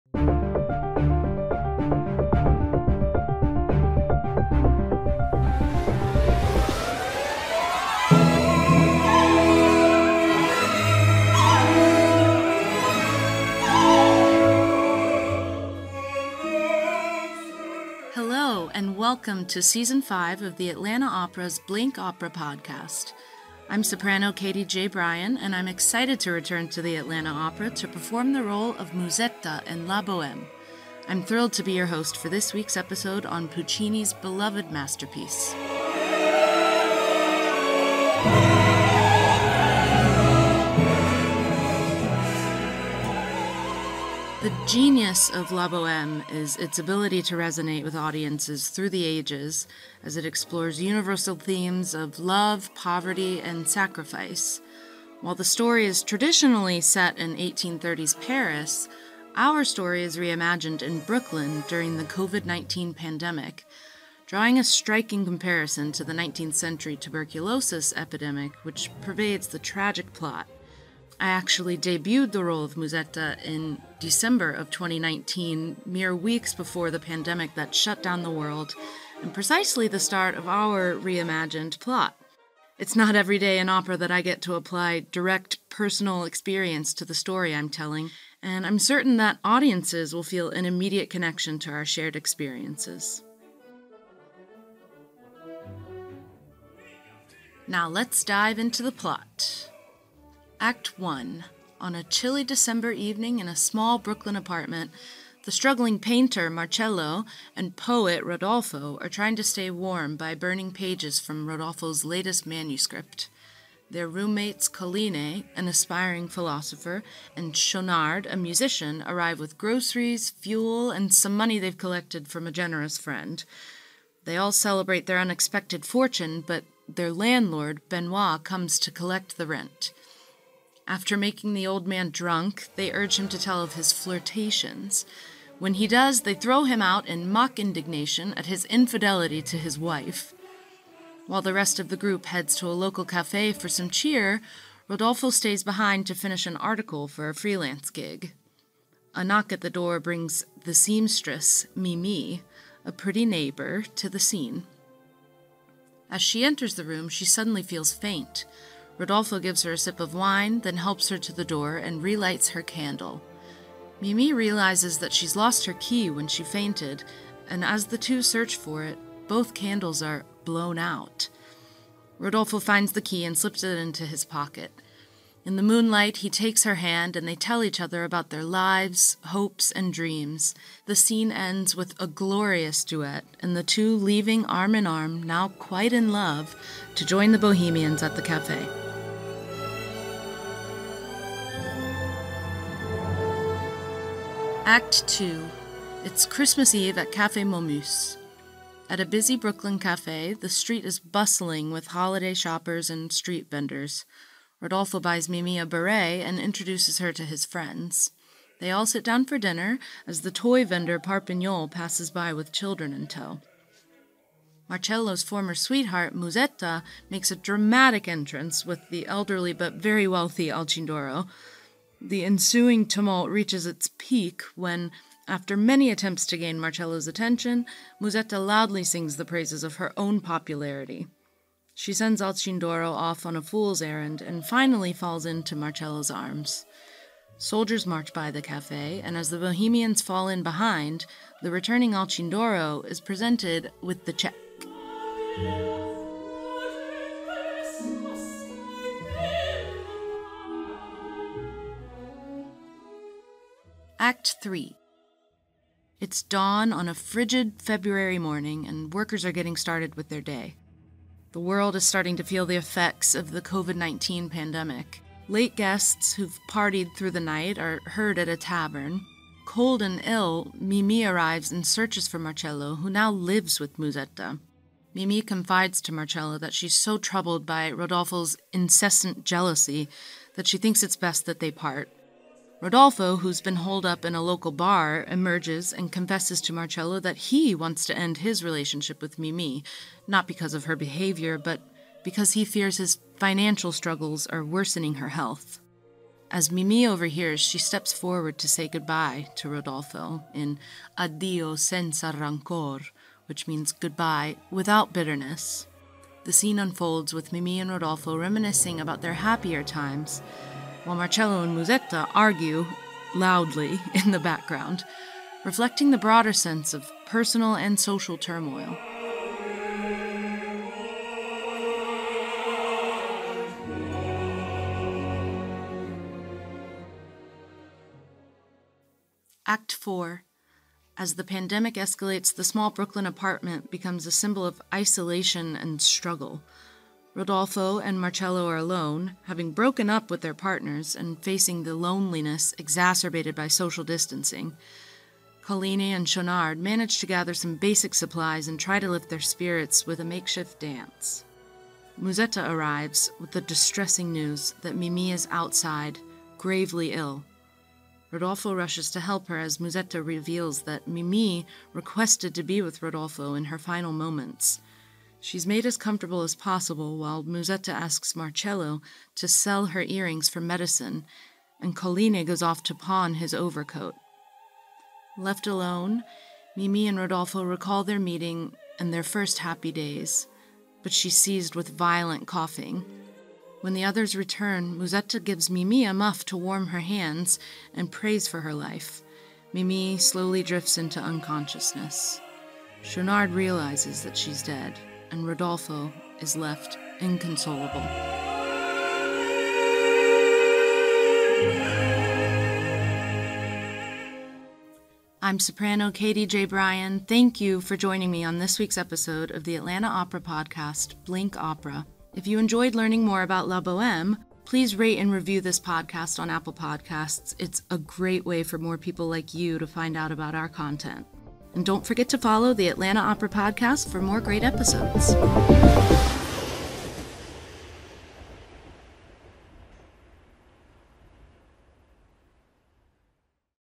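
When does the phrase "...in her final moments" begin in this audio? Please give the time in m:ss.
6:03.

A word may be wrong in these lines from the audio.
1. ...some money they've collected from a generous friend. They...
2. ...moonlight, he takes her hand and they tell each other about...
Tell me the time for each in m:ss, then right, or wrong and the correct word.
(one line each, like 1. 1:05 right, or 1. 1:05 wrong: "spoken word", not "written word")
1. 2:01 right
2. 2:55 right.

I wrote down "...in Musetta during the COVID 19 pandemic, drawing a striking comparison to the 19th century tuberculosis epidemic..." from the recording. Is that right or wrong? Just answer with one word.
wrong.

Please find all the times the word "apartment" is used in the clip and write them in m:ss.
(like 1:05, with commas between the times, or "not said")
1:44, 5:33.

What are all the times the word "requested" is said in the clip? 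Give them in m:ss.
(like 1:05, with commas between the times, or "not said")
6:01.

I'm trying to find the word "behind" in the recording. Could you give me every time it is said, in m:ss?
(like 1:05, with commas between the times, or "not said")
2:25, 4:00.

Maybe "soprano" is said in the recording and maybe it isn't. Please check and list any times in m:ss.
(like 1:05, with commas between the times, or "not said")
0:23, 6:45.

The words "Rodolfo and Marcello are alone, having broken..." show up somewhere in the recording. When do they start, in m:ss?
5:37.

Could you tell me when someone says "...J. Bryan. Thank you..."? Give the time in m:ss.
6:46.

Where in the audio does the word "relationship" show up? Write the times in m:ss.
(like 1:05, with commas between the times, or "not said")
4:48.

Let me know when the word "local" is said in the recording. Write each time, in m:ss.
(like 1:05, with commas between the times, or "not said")
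2:22, 4:44.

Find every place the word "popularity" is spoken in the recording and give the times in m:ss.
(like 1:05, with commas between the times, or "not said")
3:50.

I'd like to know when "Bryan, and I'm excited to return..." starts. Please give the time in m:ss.
0:24.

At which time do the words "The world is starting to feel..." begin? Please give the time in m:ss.
4:21.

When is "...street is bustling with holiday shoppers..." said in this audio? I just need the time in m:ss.
3:20.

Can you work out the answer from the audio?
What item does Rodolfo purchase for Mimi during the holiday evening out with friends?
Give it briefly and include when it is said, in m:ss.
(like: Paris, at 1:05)
A beret, at 3:25.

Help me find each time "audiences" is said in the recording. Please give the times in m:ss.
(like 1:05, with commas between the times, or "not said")
0:47, 1:29.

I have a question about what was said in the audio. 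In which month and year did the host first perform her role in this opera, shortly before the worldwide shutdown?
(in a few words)
December 2019.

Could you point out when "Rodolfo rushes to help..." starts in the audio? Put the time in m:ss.
5:58.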